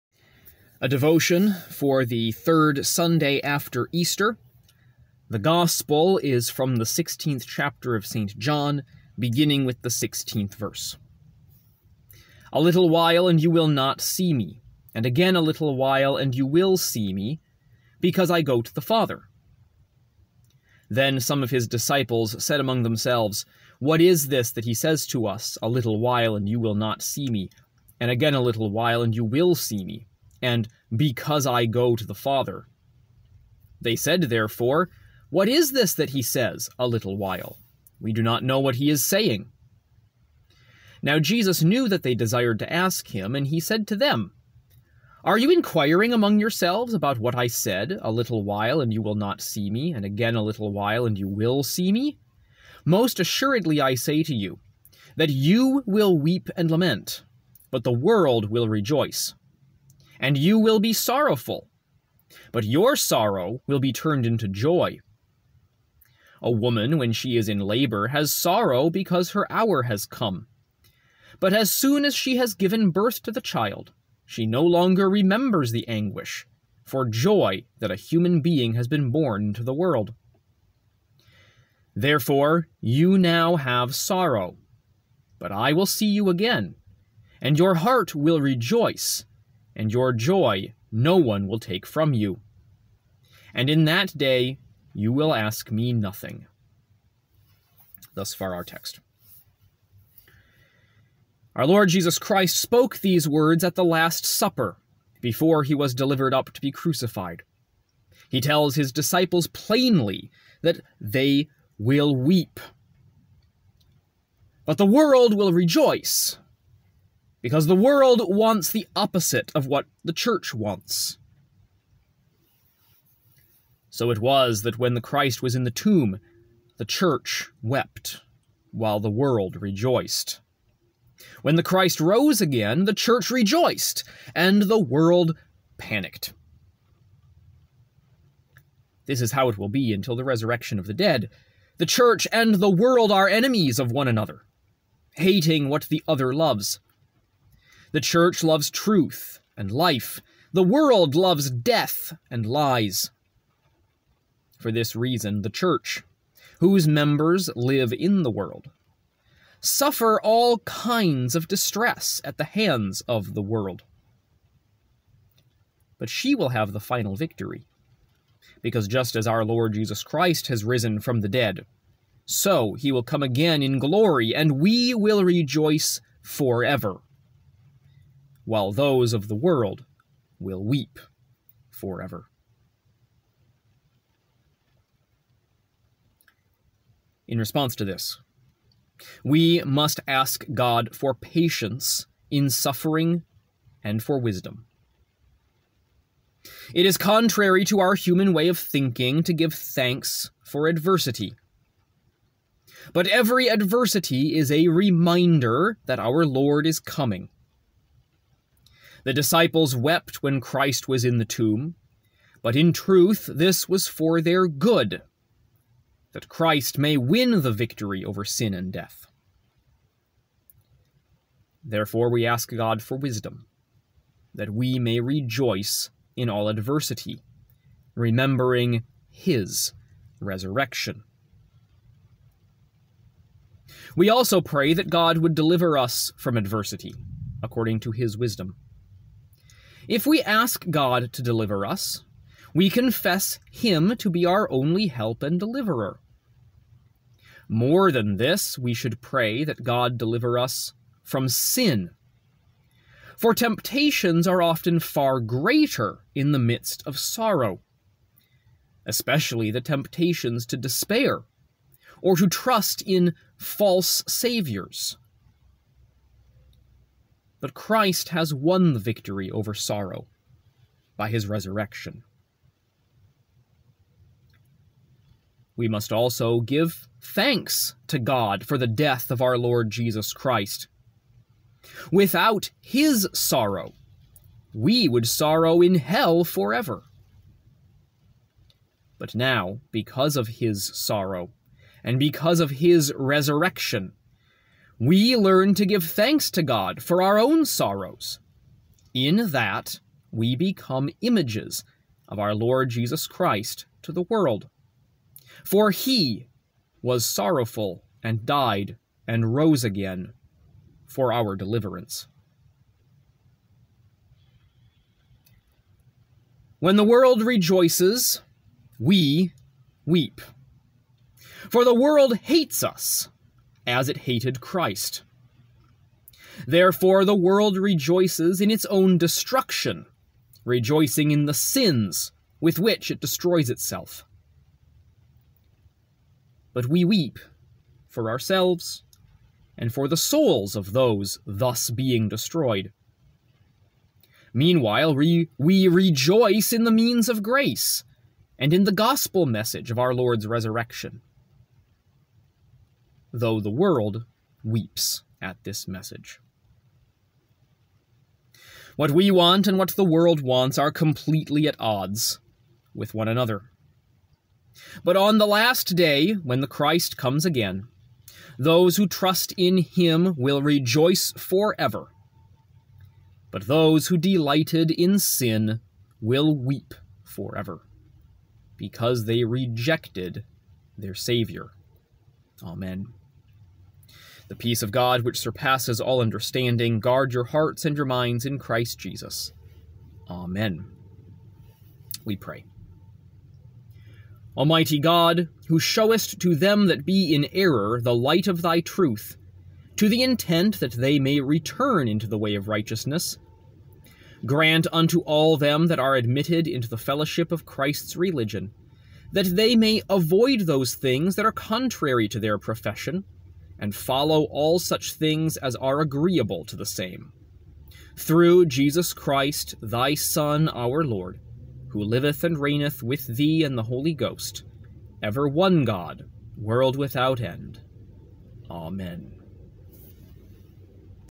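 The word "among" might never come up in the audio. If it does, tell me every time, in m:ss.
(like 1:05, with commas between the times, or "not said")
0:22, 0:46.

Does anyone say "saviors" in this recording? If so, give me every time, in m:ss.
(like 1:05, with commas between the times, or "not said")
4:24, 6:20.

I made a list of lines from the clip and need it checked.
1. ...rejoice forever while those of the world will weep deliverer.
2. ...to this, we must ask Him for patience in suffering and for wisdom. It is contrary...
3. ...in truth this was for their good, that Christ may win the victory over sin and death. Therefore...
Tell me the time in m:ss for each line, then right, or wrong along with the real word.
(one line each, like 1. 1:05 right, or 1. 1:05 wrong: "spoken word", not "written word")
1. 2:55 wrong: "forever", not "deliverer"
2. 3:07 wrong: "God", not "Him"
3. 3:32 right.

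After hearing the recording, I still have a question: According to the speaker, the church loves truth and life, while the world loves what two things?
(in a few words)
Death and lies.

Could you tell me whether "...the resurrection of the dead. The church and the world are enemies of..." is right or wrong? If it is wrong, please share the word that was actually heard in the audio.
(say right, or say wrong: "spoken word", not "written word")
right.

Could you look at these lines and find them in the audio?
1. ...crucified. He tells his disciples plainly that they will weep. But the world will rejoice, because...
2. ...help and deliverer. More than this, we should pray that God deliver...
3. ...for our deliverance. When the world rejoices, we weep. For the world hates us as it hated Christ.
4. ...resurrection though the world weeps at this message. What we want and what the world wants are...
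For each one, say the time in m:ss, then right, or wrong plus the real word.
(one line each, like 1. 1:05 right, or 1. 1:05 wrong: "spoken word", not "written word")
1. 1:46 right
2. 4:04 right
3. 5:10 right
4. 5:50 right.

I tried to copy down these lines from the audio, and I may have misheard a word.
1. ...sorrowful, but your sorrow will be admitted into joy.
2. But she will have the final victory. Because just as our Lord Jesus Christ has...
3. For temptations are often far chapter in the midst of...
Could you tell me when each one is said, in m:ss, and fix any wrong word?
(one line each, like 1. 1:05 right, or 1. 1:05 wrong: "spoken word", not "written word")
1. 1:00 wrong: "turned", not "admitted"
2. 2:45 right
3. 4:13 wrong: "greater", not "chapter".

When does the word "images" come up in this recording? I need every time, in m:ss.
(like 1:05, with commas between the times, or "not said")
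5:01.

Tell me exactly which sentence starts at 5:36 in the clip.
But we weep for ourselves and for the souls of those thus being destroyed.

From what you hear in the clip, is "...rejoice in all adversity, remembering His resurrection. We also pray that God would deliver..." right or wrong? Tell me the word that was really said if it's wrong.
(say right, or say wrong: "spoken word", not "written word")
right.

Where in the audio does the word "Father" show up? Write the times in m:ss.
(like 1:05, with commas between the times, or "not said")
0:18, 0:32.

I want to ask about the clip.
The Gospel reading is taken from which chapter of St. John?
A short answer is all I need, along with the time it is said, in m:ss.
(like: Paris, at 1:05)
16th, at 0:06.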